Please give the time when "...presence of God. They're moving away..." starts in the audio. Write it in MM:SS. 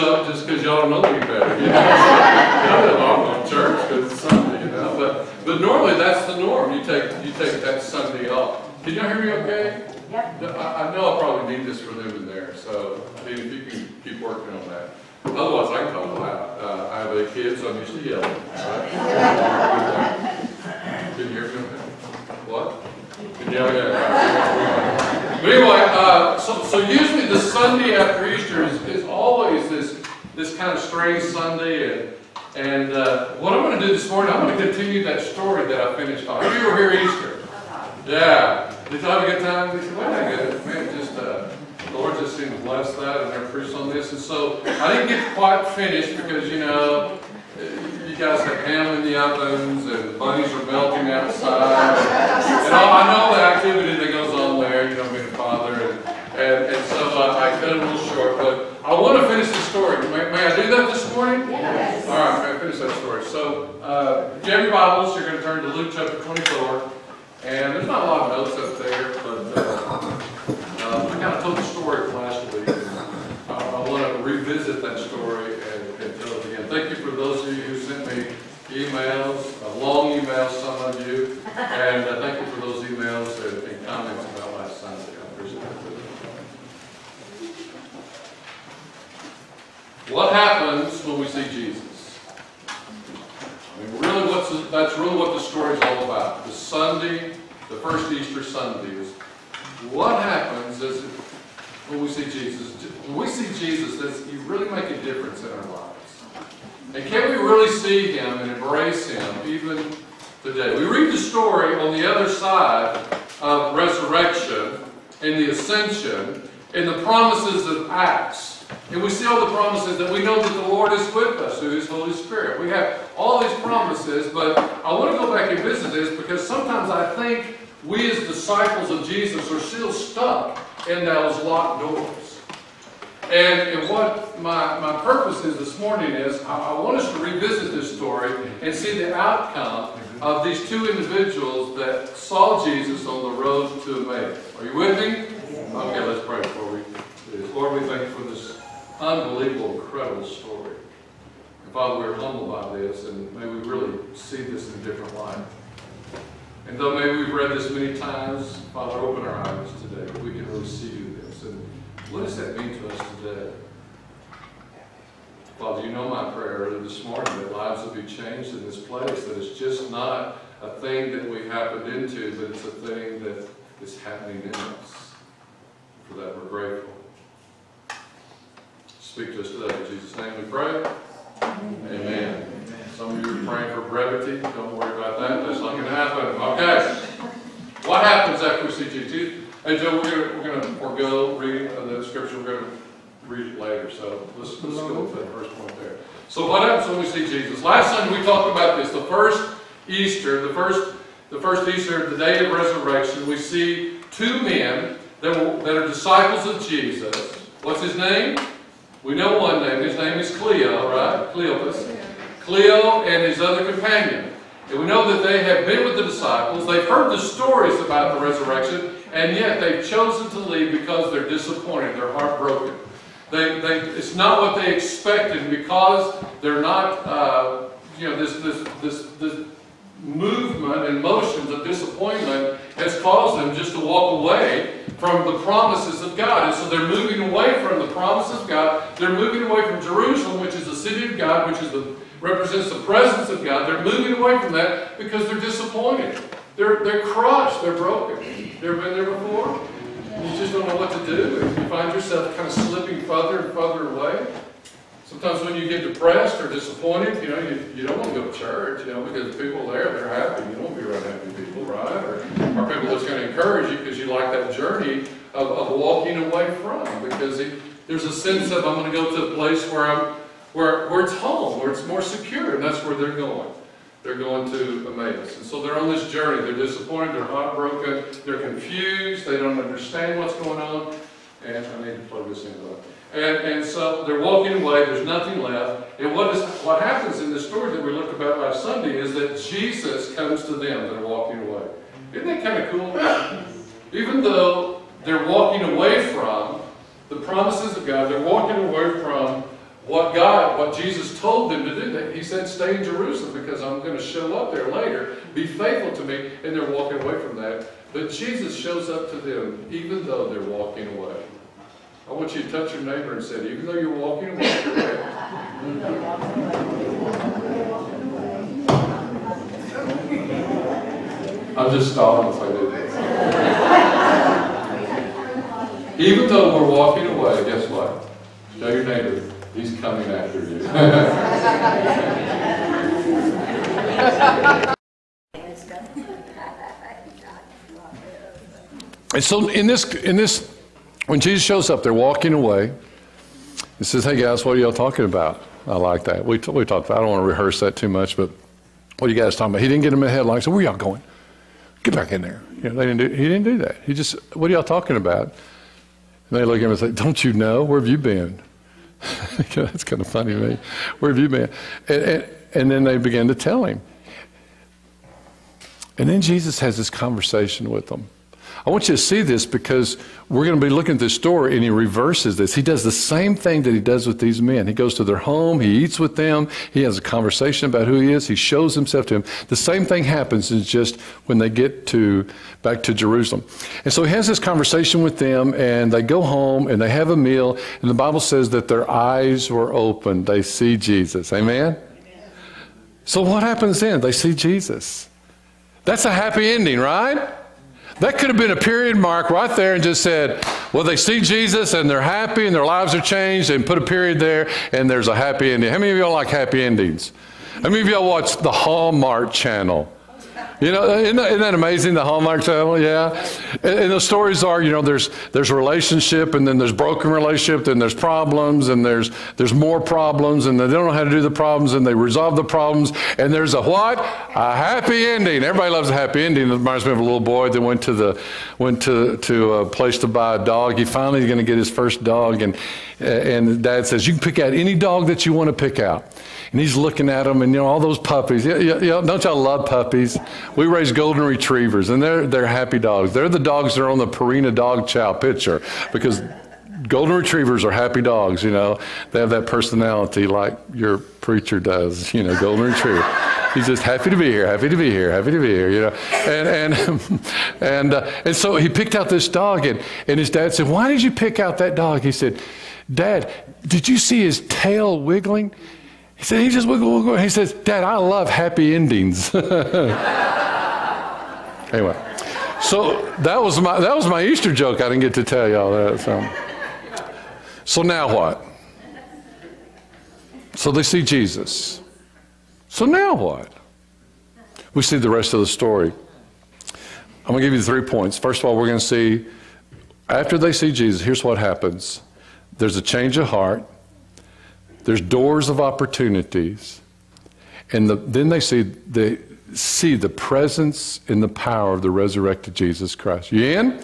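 04:02.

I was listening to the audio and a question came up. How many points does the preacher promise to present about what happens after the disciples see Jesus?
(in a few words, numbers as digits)
3.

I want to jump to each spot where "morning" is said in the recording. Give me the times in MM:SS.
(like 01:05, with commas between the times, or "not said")
00:34, 01:01, 02:15, 02:47.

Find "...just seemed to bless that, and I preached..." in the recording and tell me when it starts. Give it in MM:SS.
00:42.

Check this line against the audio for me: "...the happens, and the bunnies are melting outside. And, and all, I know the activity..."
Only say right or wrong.
wrong.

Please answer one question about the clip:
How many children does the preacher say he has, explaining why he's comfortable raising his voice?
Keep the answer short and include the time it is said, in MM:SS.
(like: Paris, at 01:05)
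8, at 00:17.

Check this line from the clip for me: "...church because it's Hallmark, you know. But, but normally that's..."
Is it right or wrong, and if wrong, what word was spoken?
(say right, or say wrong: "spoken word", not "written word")
wrong: "Sunday", not "Hallmark".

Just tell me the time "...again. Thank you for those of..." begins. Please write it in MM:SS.
01:16.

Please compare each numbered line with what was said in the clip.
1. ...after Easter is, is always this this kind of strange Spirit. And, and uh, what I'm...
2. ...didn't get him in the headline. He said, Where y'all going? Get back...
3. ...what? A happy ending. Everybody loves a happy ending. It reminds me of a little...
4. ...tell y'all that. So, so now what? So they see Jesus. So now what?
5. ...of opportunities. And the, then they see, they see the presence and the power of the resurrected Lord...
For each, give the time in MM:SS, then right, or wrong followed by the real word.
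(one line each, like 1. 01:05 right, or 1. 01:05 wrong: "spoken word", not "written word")
1. 00:27 wrong: "Sunday", not "Spirit"
2. 05:49 right
3. 07:03 right
4. 07:55 right
5. 08:15 wrong: "Jesus", not "Lord".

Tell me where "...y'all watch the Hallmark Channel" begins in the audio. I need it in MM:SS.
06:47.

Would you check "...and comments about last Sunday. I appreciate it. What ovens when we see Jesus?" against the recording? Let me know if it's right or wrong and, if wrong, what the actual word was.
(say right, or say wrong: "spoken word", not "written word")
wrong: "happens", not "ovens".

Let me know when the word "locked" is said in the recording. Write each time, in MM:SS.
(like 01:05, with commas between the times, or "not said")
02:11.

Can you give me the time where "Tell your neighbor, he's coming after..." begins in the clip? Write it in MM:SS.
05:28.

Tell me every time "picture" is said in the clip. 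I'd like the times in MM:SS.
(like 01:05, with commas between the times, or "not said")
07:25.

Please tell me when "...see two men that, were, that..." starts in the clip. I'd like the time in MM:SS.
03:23.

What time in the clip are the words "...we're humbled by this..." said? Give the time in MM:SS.
02:32.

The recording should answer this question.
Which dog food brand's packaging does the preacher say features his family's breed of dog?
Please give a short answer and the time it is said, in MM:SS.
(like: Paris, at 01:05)
Purina Dog Chow, at 07:24.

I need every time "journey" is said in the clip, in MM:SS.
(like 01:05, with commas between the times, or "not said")
04:24, 04:36.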